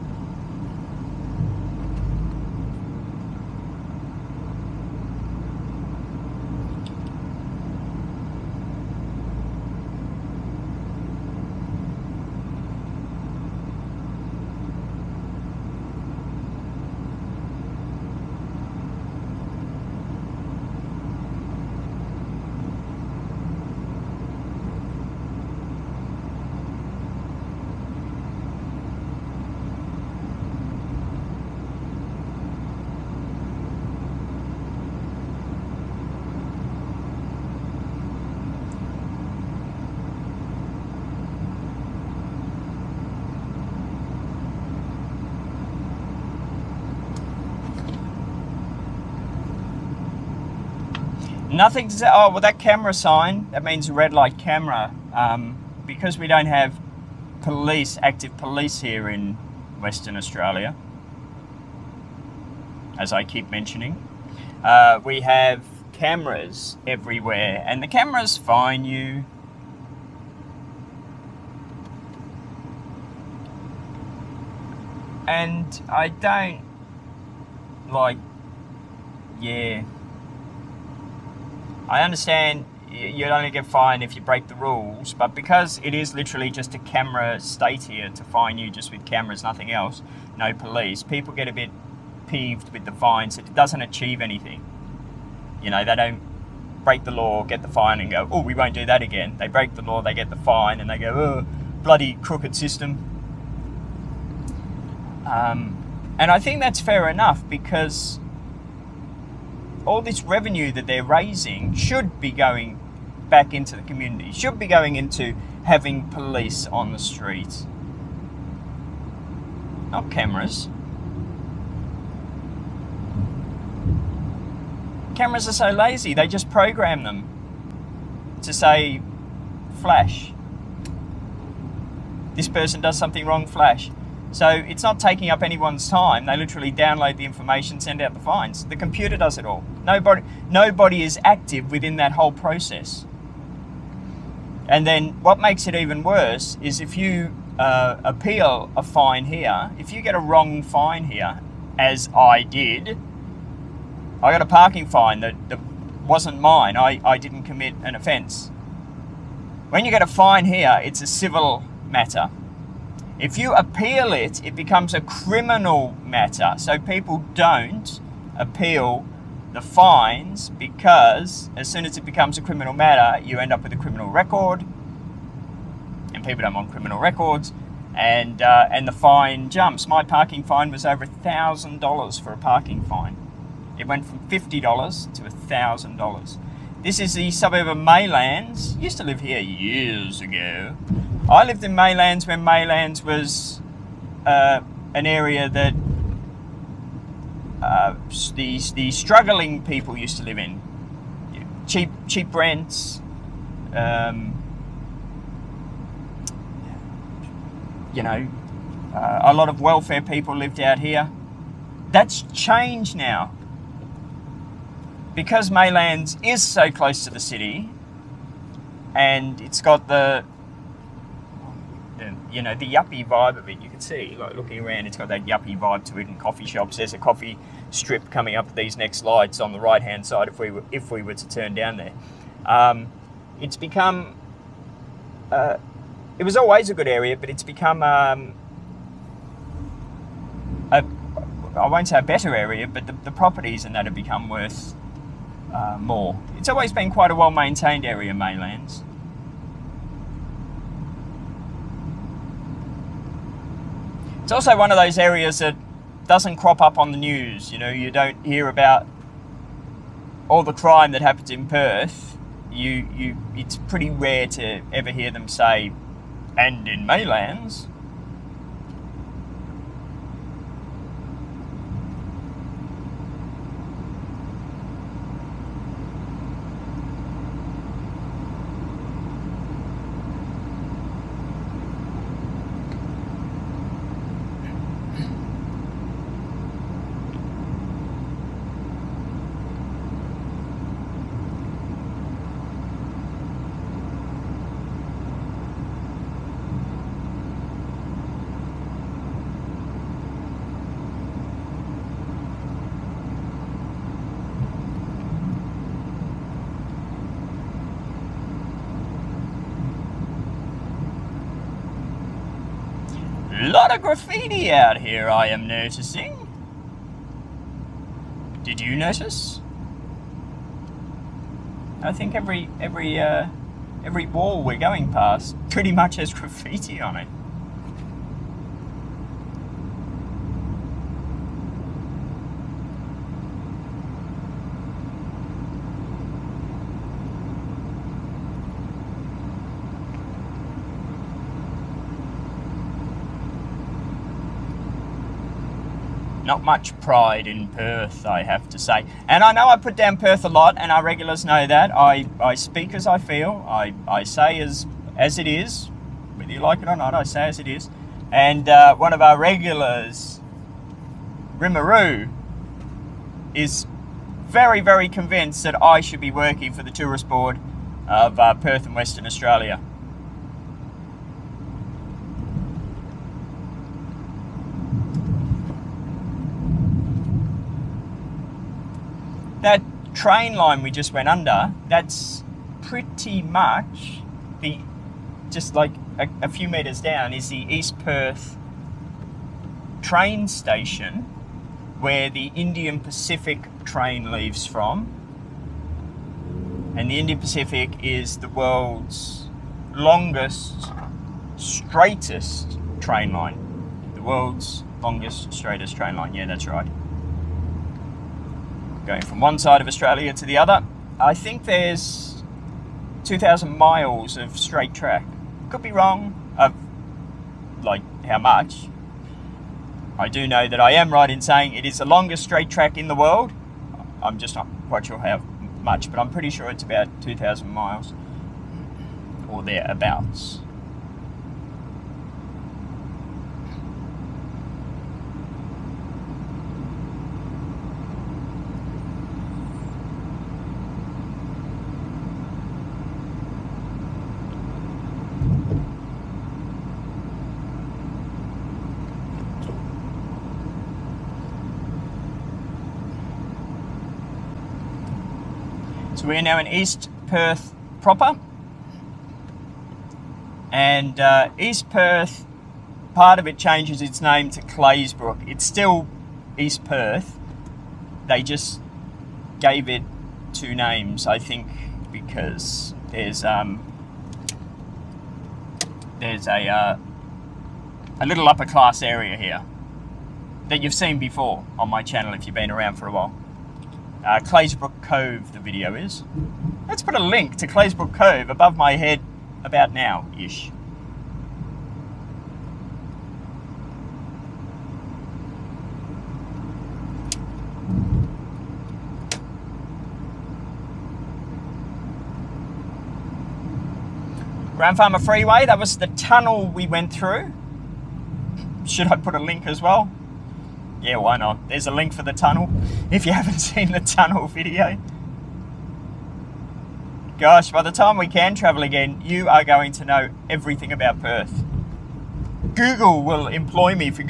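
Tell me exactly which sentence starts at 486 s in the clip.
Let's put a link to Claisebrook Cove above my head about now ish.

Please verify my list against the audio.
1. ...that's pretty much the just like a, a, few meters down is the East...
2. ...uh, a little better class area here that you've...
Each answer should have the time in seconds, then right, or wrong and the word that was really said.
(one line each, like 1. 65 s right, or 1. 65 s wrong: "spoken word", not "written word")
1. 381 s right
2. 476 s wrong: "upper", not "better".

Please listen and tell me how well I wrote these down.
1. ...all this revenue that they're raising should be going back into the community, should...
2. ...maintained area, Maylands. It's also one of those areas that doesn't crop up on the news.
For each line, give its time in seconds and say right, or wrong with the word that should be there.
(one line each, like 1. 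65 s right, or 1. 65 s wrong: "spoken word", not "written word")
1. 109 s right
2. 247 s right.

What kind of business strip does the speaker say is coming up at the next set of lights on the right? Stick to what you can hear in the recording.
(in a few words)
Coffee strip.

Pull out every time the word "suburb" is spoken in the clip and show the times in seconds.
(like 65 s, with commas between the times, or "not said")
187 s.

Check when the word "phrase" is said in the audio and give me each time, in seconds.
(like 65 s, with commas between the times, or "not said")
not said.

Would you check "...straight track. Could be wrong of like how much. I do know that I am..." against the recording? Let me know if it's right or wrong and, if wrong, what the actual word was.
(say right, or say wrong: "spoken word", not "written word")
right.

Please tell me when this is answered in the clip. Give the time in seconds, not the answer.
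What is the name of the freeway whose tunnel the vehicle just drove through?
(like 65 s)
504 s.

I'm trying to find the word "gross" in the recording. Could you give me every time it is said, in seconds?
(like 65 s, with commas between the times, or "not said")
not said.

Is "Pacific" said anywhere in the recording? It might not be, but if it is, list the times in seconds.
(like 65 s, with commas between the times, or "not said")
392 s, 397 s.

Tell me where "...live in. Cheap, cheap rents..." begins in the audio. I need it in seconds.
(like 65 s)
200 s.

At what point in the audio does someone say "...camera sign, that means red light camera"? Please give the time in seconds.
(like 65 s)
52 s.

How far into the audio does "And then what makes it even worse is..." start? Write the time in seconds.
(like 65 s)
144 s.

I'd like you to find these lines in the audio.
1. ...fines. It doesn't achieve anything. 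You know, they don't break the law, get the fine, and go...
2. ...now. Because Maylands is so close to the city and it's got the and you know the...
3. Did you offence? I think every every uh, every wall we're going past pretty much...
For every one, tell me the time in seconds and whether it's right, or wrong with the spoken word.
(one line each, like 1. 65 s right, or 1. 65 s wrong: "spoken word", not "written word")
1. 92 s right
2. 212 s right
3. 318 s wrong: "notice", not "offence".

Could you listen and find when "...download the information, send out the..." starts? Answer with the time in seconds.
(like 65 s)
136 s.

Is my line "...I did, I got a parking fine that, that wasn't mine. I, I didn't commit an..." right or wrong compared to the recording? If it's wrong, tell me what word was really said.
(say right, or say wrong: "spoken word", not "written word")
right.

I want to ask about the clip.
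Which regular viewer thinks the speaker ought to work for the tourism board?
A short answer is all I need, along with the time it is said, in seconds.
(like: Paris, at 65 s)
Rimaru, at 361 s.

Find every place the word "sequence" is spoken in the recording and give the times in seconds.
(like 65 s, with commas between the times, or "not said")
not said.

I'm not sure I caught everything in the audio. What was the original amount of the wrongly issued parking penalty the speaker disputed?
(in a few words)
$50.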